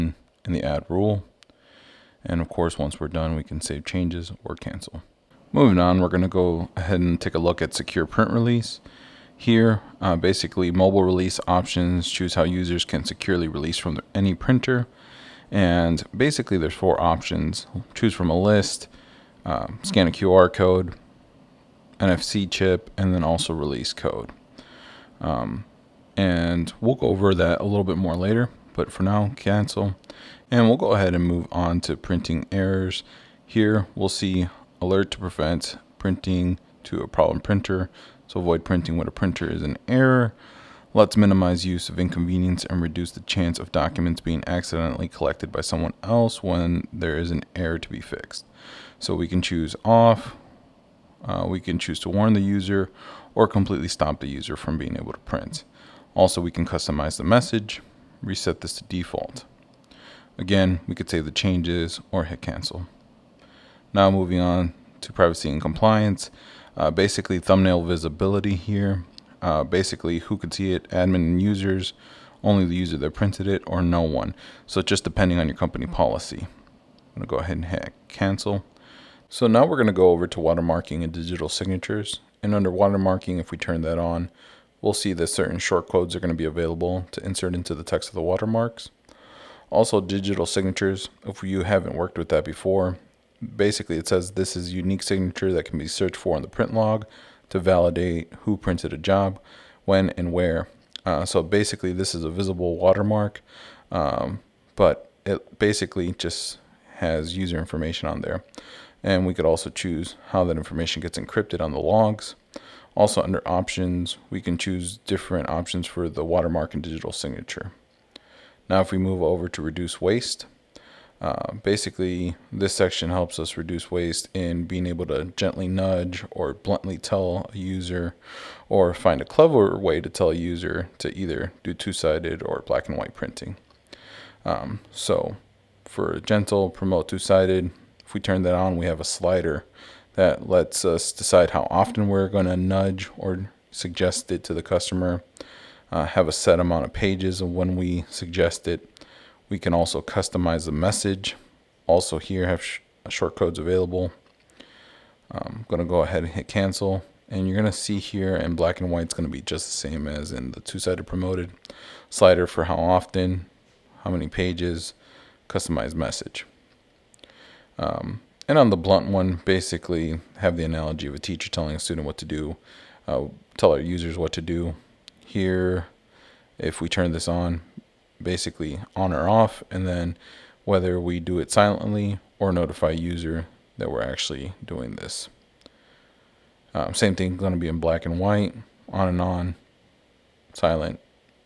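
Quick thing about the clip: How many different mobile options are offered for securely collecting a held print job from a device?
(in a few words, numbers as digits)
4.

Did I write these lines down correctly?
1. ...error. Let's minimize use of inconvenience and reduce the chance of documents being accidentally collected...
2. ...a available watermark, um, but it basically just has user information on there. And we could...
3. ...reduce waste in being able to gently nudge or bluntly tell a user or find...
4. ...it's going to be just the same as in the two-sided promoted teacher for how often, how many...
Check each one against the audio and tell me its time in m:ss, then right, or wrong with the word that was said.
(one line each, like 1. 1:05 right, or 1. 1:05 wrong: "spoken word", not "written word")
1. 0:39 right
2. 1:42 wrong: "visible", not "available"
3. 2:03 right
4. 2:39 wrong: "slider", not "teacher".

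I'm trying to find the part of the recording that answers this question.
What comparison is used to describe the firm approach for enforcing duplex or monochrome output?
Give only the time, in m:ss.
2:51.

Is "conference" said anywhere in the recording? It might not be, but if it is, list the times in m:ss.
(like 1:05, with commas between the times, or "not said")
not said.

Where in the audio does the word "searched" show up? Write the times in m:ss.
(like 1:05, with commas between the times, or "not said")
1:35.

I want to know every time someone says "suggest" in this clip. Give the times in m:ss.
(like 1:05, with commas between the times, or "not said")
2:23, 2:28.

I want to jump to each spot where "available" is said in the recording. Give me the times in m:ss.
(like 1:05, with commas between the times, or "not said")
1:26, 2:33.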